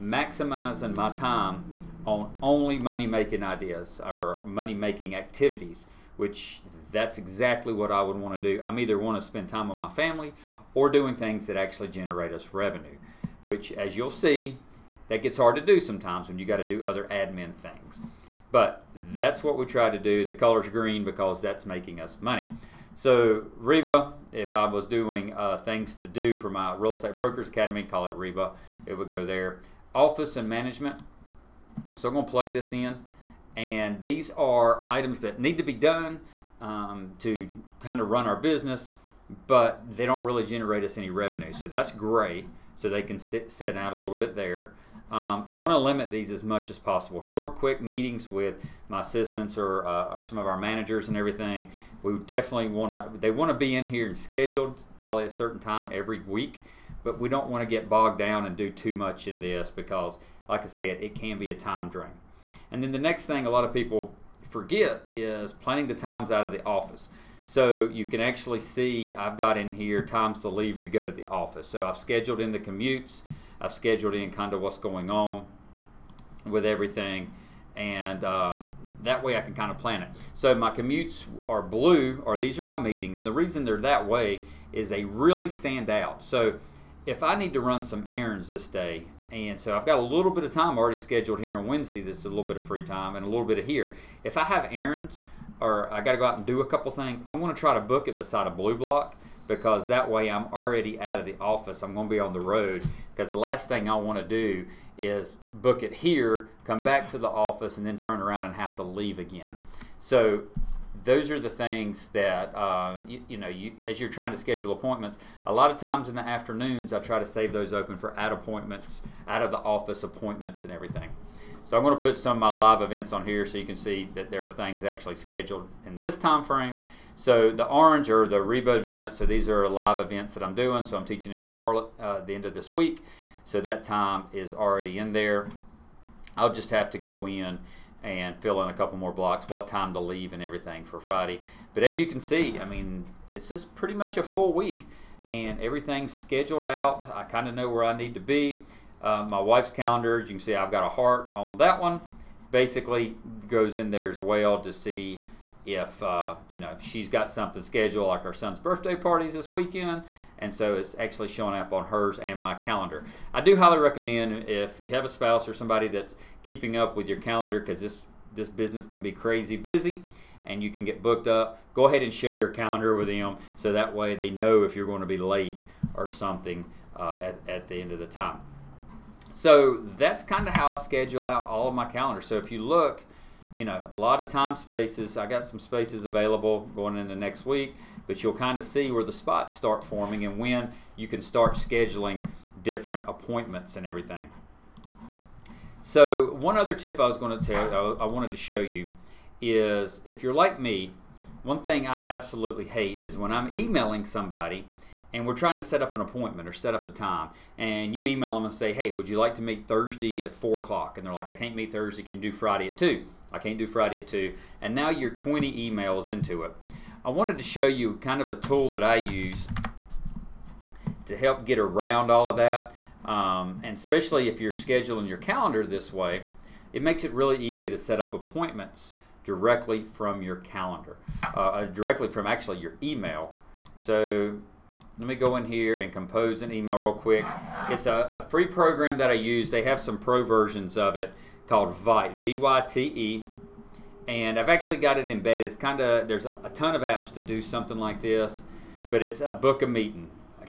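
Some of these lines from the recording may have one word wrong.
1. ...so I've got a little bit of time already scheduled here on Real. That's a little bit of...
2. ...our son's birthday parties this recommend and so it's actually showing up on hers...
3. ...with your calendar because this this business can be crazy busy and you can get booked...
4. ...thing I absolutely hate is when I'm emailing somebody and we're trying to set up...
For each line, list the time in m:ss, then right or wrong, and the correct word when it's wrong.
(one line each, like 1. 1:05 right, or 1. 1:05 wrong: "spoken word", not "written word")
1. 1:29 wrong: "Wednesday", not "Real"
2. 2:38 wrong: "weekend", not "recommend"
3. 2:46 right
4. 3:21 right.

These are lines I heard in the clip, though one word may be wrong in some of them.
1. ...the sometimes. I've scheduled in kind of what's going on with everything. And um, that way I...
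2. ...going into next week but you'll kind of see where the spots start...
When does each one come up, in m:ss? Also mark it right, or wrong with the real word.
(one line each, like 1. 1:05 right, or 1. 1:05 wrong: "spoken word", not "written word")
1. 1:12 wrong: "commutes", not "sometimes"
2. 3:06 right.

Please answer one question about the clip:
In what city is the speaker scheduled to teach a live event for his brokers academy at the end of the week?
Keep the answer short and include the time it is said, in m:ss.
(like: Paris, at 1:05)
Charlotte, at 2:11.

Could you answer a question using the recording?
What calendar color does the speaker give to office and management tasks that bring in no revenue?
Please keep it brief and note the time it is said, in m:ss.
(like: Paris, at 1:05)
gray, at 0:41.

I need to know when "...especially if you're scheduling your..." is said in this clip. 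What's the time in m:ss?
3:43.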